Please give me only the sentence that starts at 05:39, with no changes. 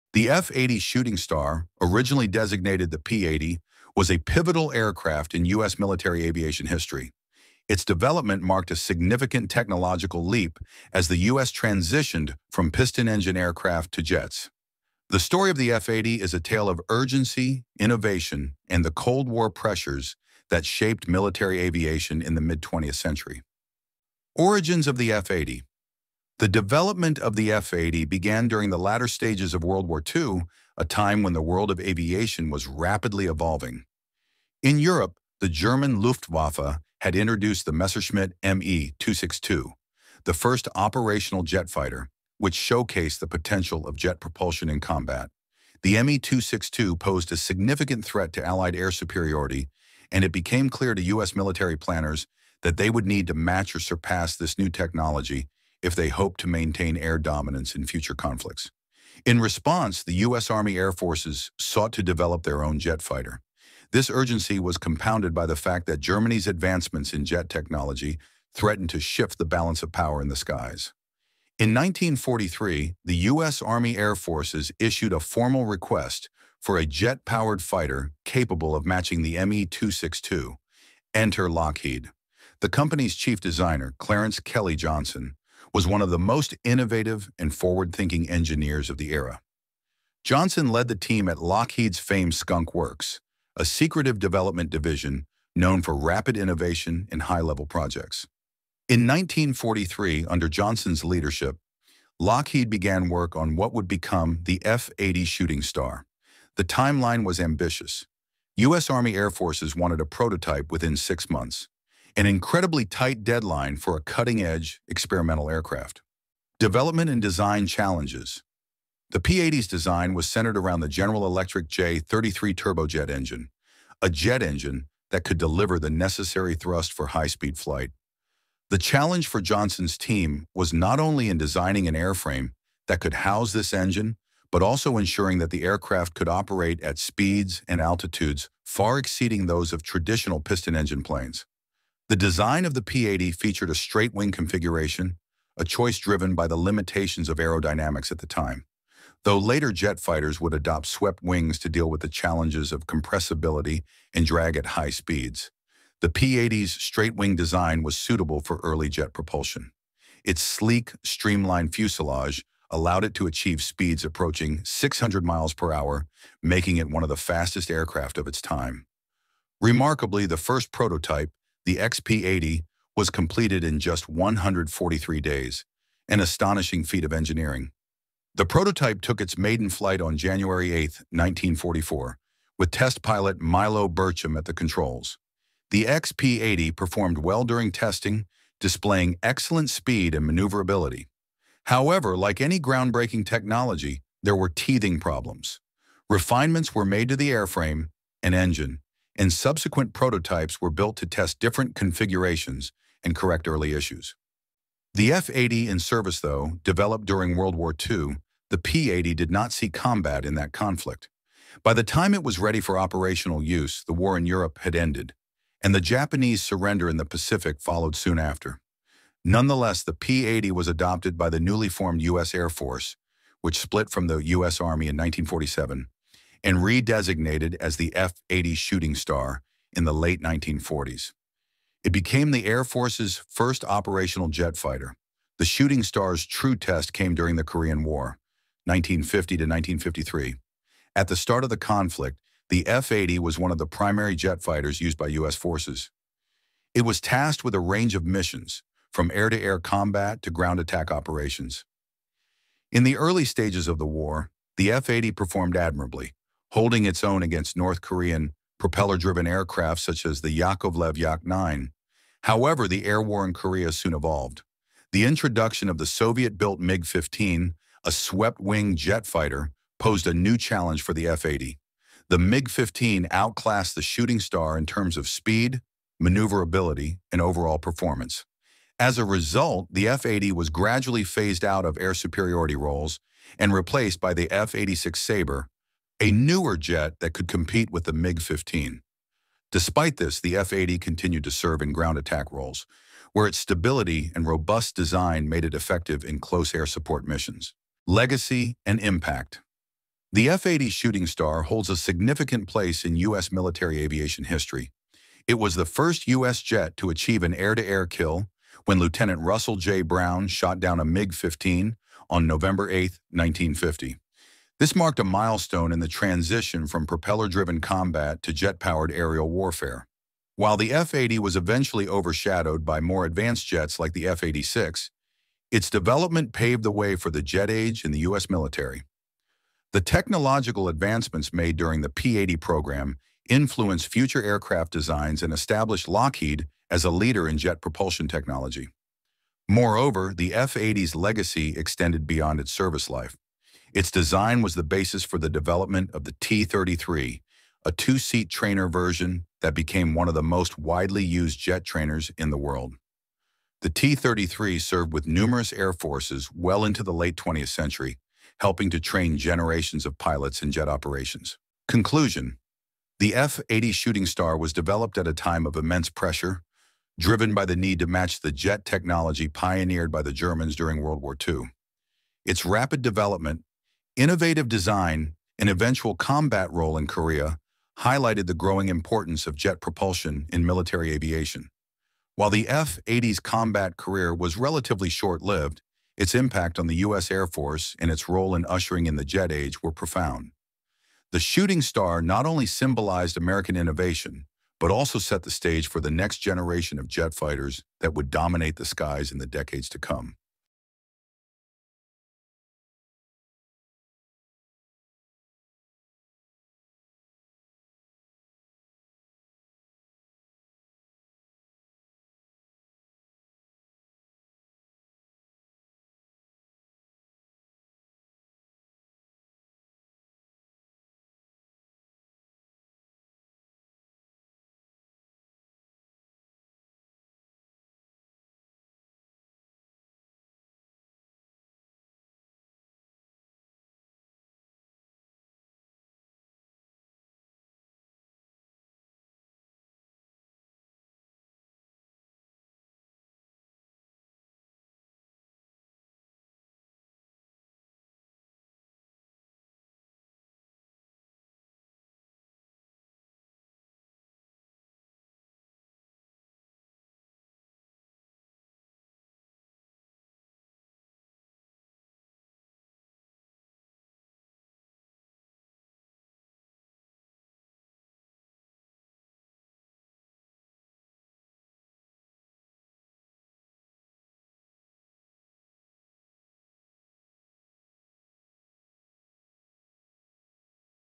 Moreover, the F-80's legacy extended beyond its service life.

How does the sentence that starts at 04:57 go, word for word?
Legacy and Impact The F-80 Shooting Star holds a significant place in U.S.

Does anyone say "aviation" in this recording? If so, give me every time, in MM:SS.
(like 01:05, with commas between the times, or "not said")
00:06, 00:21, 00:31, 05:03, 06:20.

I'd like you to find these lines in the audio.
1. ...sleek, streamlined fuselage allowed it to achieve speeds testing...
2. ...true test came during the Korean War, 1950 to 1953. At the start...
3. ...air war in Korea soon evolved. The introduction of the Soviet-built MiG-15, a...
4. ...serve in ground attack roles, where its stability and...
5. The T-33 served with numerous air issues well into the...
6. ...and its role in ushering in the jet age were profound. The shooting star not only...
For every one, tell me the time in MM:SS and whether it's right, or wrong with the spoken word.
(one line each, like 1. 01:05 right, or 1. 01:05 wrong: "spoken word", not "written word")
1. 02:40 wrong: "approaching", not "testing"
2. 03:56 right
3. 04:22 right
4. 04:51 right
5. 05:53 wrong: "forces", not "issues"
6. 06:27 right.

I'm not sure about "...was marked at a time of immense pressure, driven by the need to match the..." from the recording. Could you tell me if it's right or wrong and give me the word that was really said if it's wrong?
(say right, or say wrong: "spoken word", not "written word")
wrong: "developed", not "marked".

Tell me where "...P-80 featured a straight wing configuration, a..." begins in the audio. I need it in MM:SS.
02:22.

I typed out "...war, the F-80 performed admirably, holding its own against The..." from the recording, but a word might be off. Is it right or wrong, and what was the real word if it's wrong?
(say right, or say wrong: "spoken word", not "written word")
wrong: "North", not "The".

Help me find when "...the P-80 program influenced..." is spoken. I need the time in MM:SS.
05:31.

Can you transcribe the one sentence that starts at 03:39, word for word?
Nonetheless, the P-80 was adopted by the newly formed U.S.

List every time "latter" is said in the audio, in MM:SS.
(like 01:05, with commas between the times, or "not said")
00:28.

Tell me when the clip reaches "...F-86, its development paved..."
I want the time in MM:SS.
05:24.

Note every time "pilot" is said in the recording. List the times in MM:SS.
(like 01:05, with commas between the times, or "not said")
03:03, 05:59.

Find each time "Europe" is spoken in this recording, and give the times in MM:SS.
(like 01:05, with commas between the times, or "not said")
00:34, 03:34.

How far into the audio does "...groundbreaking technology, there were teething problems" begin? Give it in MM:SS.
03:12.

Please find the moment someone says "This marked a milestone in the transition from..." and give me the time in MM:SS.
05:14.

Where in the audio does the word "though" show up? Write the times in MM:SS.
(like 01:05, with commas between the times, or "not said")
02:29, 03:26.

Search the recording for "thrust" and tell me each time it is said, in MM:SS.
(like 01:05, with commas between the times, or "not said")
02:06.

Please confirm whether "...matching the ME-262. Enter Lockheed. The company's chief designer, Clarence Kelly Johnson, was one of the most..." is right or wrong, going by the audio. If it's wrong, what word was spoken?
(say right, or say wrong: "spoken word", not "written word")
right.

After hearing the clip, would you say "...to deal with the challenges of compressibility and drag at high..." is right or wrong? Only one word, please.
right.